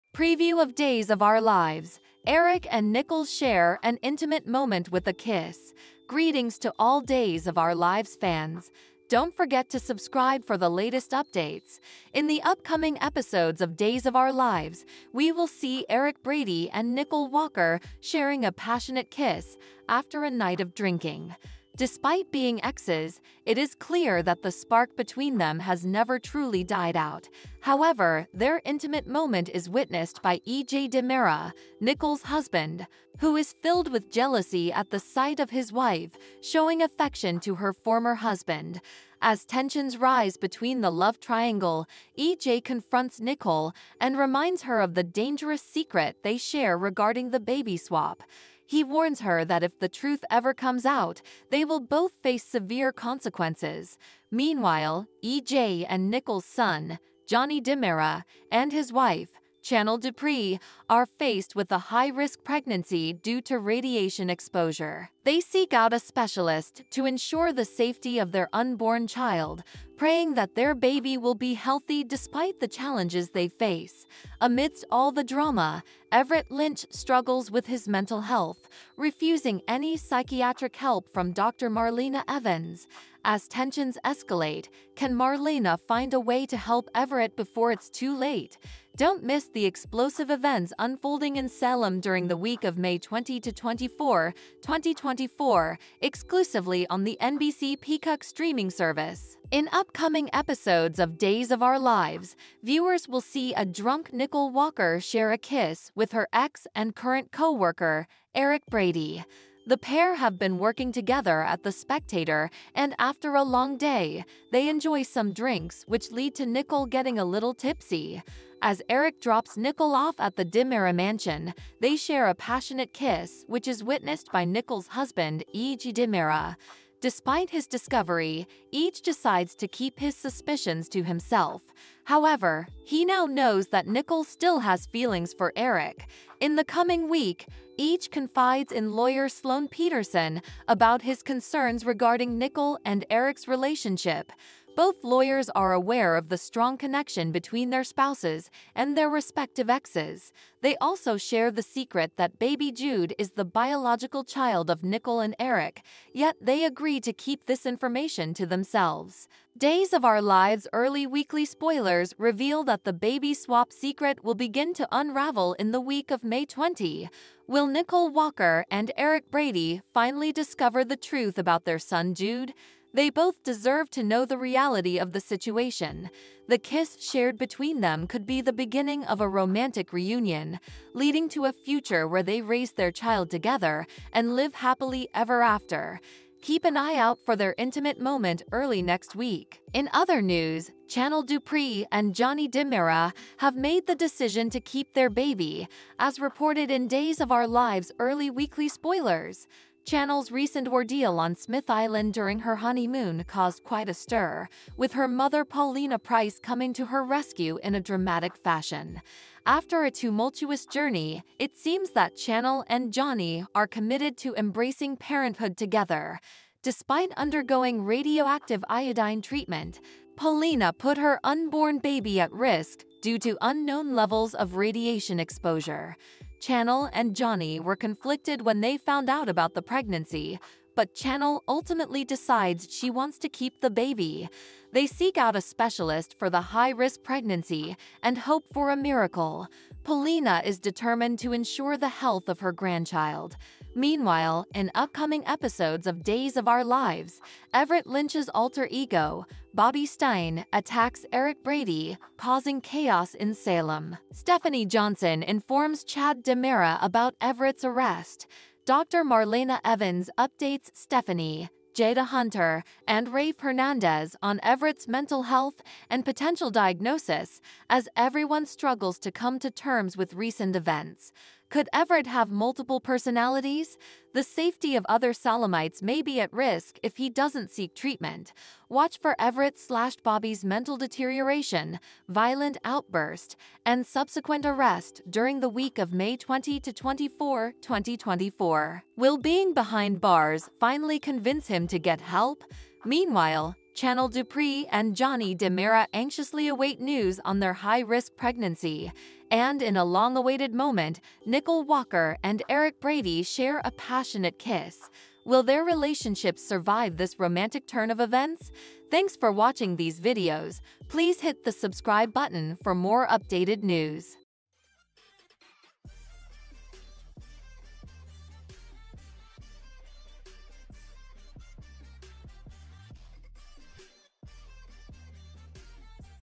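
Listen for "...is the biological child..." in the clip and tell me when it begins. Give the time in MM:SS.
02:33.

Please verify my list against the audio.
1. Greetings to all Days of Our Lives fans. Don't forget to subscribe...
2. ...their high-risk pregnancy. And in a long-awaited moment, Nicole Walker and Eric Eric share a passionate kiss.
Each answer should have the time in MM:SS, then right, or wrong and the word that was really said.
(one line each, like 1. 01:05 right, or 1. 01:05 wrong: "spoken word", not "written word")
1. 00:06 right
2. 04:57 wrong: "Brady", not "Eric".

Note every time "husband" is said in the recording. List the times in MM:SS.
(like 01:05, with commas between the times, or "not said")
00:32, 00:38, 02:04.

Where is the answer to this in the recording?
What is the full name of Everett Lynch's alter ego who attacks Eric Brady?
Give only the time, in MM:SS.
04:09.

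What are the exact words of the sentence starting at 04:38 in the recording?
Watch for Everett slash Bobby's mental deterioration, violent outburst, and subsequent arrest during the week of May 20 to 24, 2024.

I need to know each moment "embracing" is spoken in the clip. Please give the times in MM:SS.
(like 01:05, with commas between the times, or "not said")
03:34.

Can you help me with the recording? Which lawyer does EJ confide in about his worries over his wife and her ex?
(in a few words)
Sloan Petersen.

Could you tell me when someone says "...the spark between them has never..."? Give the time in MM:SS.
00:24.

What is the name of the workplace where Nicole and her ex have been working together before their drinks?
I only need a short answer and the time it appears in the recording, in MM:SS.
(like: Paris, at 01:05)
The Spectator, at 01:51.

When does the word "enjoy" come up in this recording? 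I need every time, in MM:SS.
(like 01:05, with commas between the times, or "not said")
01:54.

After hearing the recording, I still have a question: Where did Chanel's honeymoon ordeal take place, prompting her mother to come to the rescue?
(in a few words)
Smith Island.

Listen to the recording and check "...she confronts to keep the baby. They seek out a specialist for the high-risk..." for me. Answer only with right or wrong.
wrong.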